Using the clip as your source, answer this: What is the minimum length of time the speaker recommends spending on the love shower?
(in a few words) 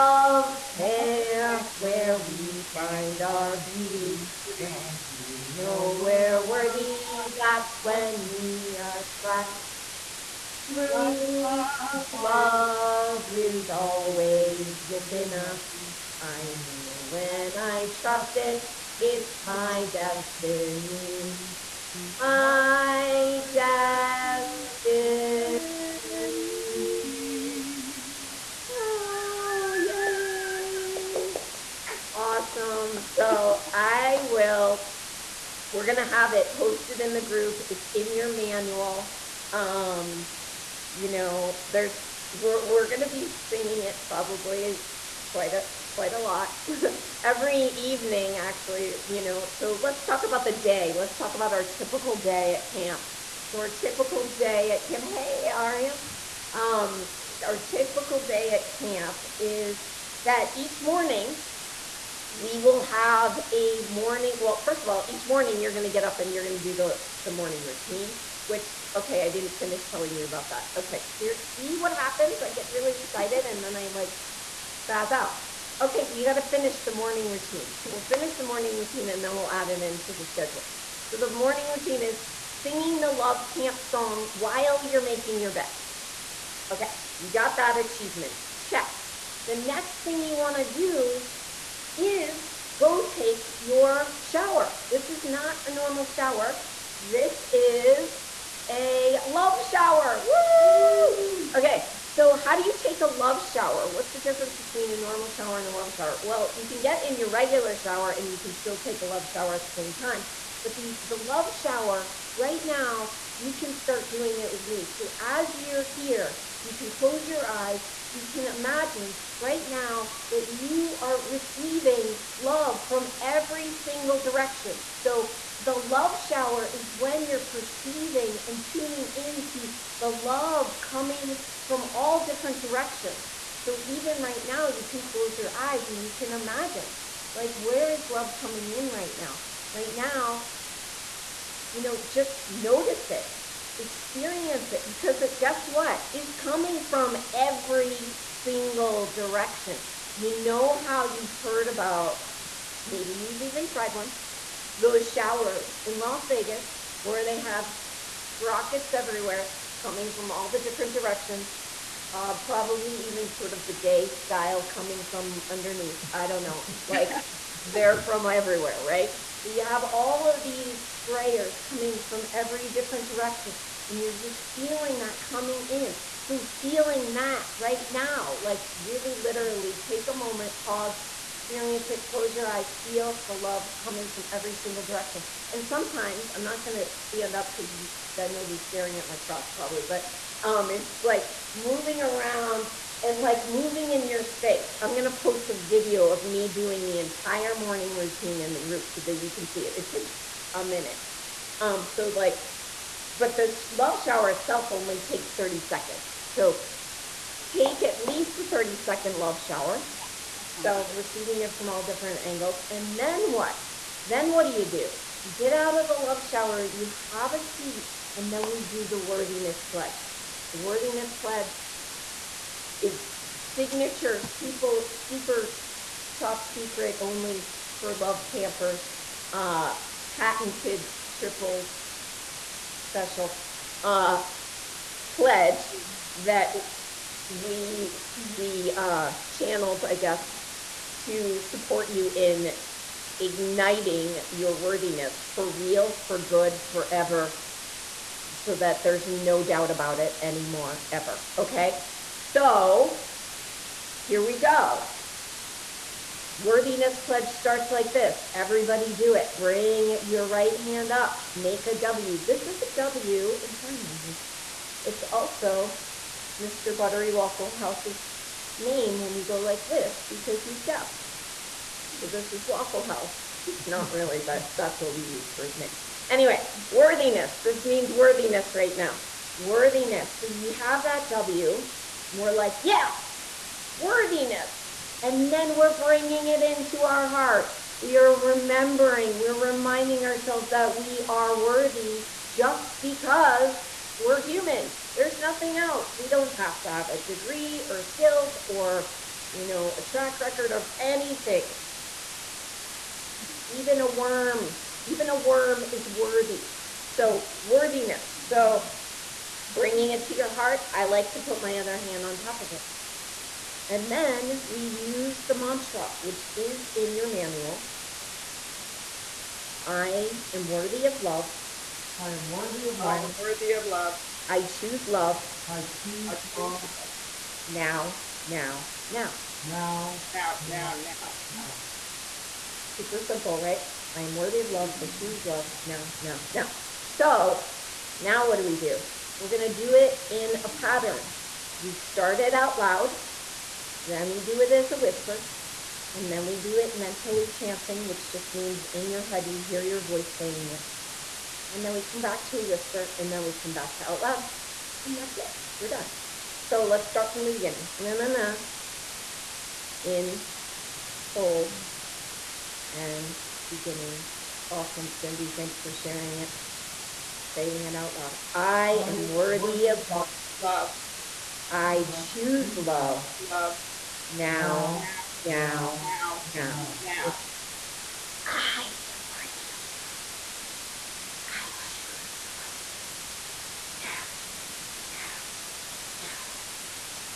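30 seconds.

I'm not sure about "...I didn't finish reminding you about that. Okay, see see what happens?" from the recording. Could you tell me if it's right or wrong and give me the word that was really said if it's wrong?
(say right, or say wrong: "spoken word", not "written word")
wrong: "telling", not "reminding".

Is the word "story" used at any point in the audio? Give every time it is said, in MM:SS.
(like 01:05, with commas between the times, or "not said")
not said.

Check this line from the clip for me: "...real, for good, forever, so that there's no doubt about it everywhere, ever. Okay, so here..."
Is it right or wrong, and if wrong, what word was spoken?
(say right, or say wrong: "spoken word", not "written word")
wrong: "anymore", not "everywhere".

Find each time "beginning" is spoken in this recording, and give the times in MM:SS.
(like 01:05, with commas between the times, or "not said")
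05:57, 06:03.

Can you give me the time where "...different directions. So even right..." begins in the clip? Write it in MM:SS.
02:12.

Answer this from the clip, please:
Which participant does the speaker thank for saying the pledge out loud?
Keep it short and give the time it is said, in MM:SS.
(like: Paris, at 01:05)
Cindy, at 06:04.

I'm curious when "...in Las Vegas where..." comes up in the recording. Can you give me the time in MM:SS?
02:35.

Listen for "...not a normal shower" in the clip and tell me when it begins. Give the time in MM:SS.
01:35.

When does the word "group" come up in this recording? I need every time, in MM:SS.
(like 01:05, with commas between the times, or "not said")
00:37, 03:18.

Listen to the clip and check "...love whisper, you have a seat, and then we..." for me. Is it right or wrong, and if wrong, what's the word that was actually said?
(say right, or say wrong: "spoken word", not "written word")
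wrong: "shower", not "whisper".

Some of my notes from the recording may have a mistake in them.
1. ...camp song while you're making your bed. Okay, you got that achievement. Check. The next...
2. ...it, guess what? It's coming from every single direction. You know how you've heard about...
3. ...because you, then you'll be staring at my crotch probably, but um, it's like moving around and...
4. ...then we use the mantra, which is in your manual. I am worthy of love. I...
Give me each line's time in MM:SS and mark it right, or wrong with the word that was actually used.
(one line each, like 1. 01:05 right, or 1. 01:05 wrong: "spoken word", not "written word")
1. 01:23 right
2. 02:25 right
3. 03:07 right
4. 05:13 right.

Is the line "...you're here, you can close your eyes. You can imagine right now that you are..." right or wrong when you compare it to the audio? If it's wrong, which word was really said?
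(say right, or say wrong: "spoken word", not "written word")
right.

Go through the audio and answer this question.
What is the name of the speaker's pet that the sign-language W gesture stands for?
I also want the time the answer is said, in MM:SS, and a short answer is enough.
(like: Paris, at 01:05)
Mr. Buttery Waffle House, at 04:26.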